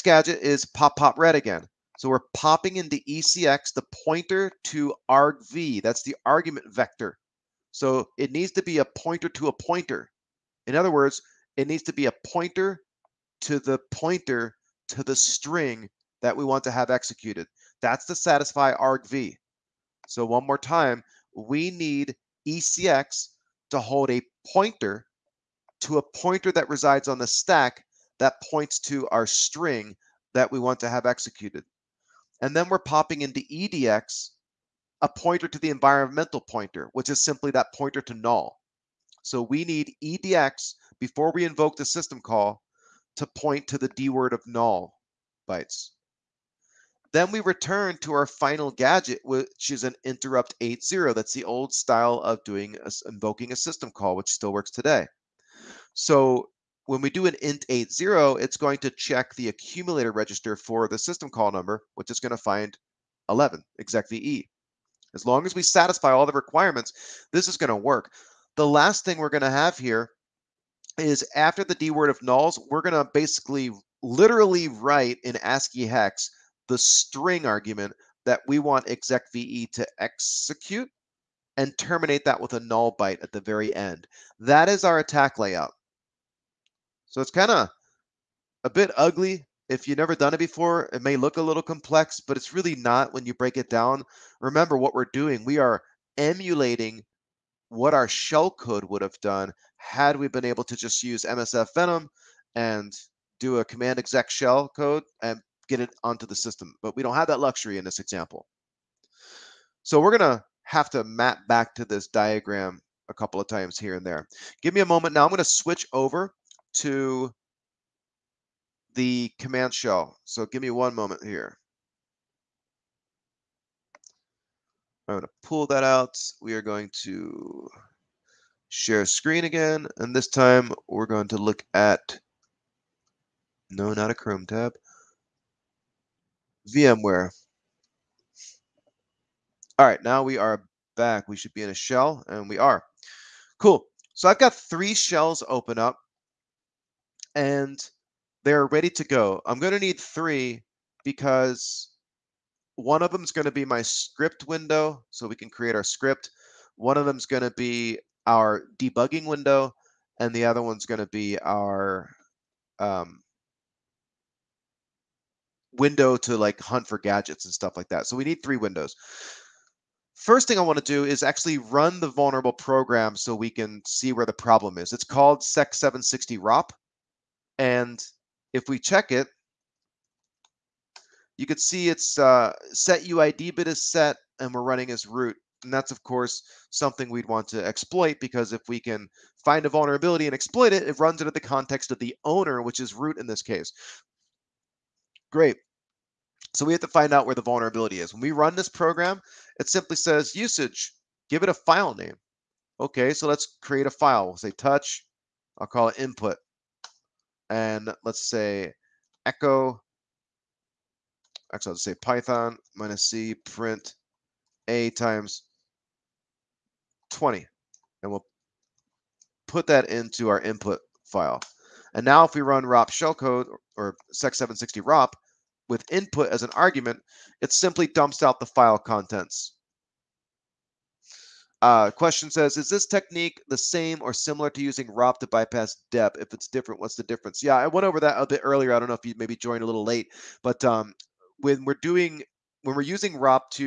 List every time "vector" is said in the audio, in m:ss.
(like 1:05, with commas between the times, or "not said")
0:06.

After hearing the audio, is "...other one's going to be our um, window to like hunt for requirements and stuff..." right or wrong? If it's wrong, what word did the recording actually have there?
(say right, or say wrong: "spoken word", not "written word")
wrong: "gadgets", not "requirements".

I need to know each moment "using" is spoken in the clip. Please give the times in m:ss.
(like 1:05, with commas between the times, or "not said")
3:54, 4:02.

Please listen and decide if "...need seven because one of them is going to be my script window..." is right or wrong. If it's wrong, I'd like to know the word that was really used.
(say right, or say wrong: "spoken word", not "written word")
wrong: "three", not "seven".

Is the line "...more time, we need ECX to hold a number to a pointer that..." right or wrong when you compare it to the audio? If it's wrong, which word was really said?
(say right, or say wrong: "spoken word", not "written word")
wrong: "pointer", not "number".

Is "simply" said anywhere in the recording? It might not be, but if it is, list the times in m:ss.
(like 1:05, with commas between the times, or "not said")
0:37, 3:19, 3:47.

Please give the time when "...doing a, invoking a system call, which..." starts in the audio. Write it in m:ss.
0:52.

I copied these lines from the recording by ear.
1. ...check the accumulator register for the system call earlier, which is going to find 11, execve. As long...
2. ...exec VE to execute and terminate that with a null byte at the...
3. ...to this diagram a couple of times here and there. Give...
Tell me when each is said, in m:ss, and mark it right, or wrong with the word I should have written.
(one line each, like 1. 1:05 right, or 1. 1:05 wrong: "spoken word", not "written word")
1. 0:58 wrong: "number", not "earlier"
2. 1:18 right
3. 1:51 right.